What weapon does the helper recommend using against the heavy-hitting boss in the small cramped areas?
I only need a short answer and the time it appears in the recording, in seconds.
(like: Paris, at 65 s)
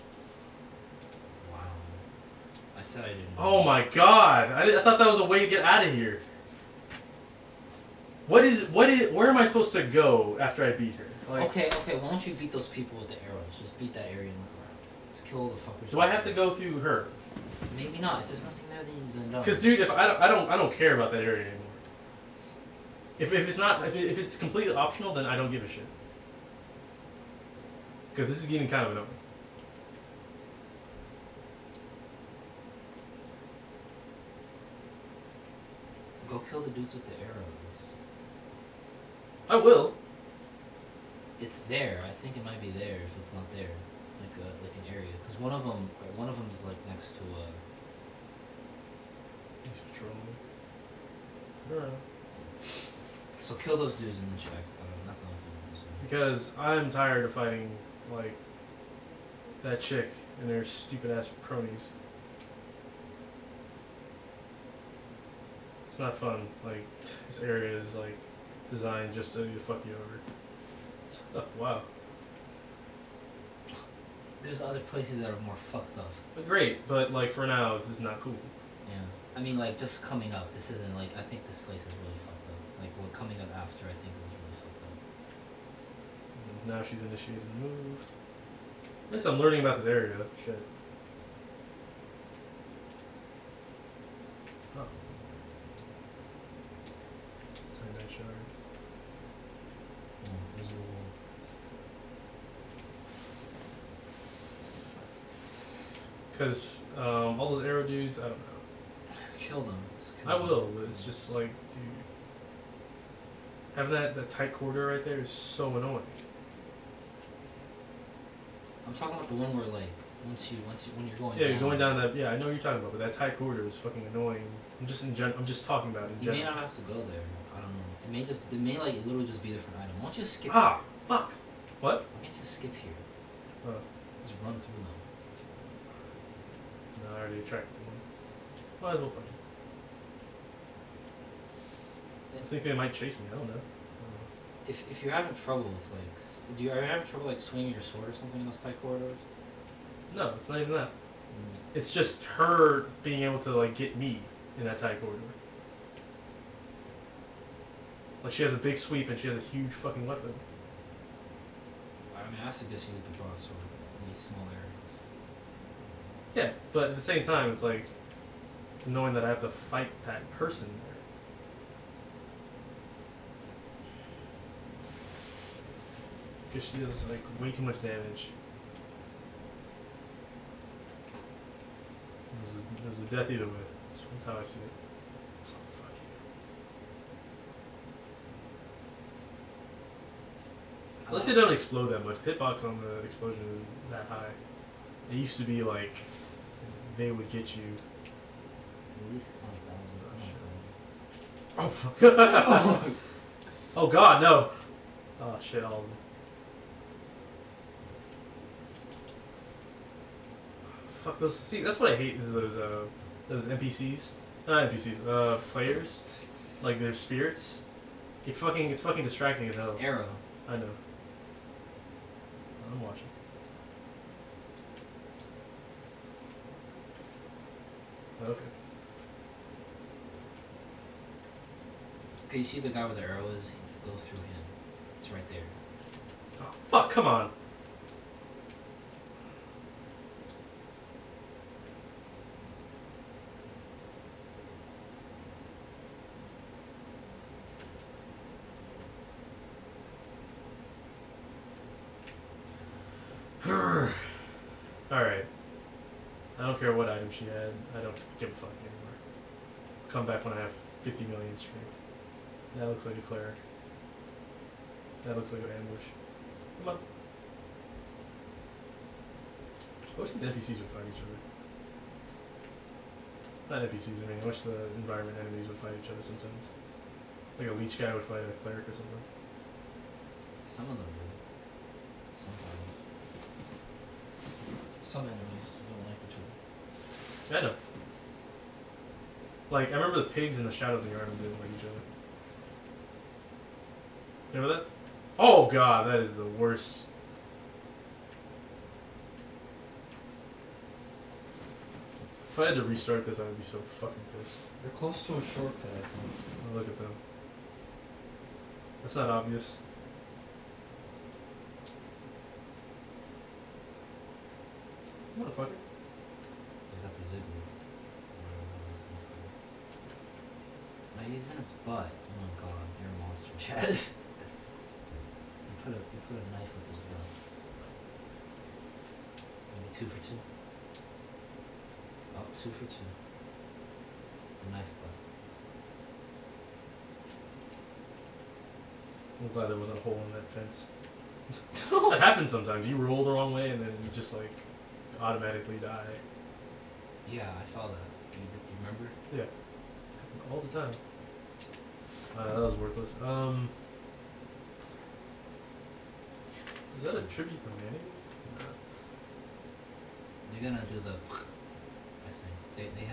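broadsword, at 163 s.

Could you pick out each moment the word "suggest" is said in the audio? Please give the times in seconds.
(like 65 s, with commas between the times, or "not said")
162 s.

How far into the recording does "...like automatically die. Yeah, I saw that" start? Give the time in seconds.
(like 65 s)
344 s.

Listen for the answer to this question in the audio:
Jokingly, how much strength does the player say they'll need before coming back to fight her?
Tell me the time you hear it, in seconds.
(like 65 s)
260 s.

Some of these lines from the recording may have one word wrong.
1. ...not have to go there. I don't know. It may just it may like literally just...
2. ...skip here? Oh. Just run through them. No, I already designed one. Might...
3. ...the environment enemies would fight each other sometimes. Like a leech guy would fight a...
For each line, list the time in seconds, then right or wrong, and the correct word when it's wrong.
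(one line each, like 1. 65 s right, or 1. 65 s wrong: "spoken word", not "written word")
1. 126 s right
2. 132 s wrong: "attracted", not "designed"
3. 274 s right.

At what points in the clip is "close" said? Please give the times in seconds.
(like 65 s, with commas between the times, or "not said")
304 s.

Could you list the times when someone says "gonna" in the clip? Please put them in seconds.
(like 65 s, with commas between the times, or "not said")
360 s.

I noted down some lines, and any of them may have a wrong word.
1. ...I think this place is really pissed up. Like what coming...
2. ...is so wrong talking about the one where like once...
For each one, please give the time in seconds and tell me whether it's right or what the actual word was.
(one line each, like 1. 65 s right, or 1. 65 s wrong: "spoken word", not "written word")
1. 81 s wrong: "fucked", not "pissed"
2. 115 s wrong: "annoying", not "wrong".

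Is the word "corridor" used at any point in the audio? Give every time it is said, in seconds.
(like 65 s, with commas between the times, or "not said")
114 s, 123 s, 148 s, 155 s.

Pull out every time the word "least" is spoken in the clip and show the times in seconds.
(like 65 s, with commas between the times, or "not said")
89 s, 199 s.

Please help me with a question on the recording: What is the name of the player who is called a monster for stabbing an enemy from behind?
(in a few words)
Chaz.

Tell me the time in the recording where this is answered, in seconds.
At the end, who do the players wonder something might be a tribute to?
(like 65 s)
357 s.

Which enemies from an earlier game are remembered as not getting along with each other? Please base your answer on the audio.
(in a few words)
the pigs.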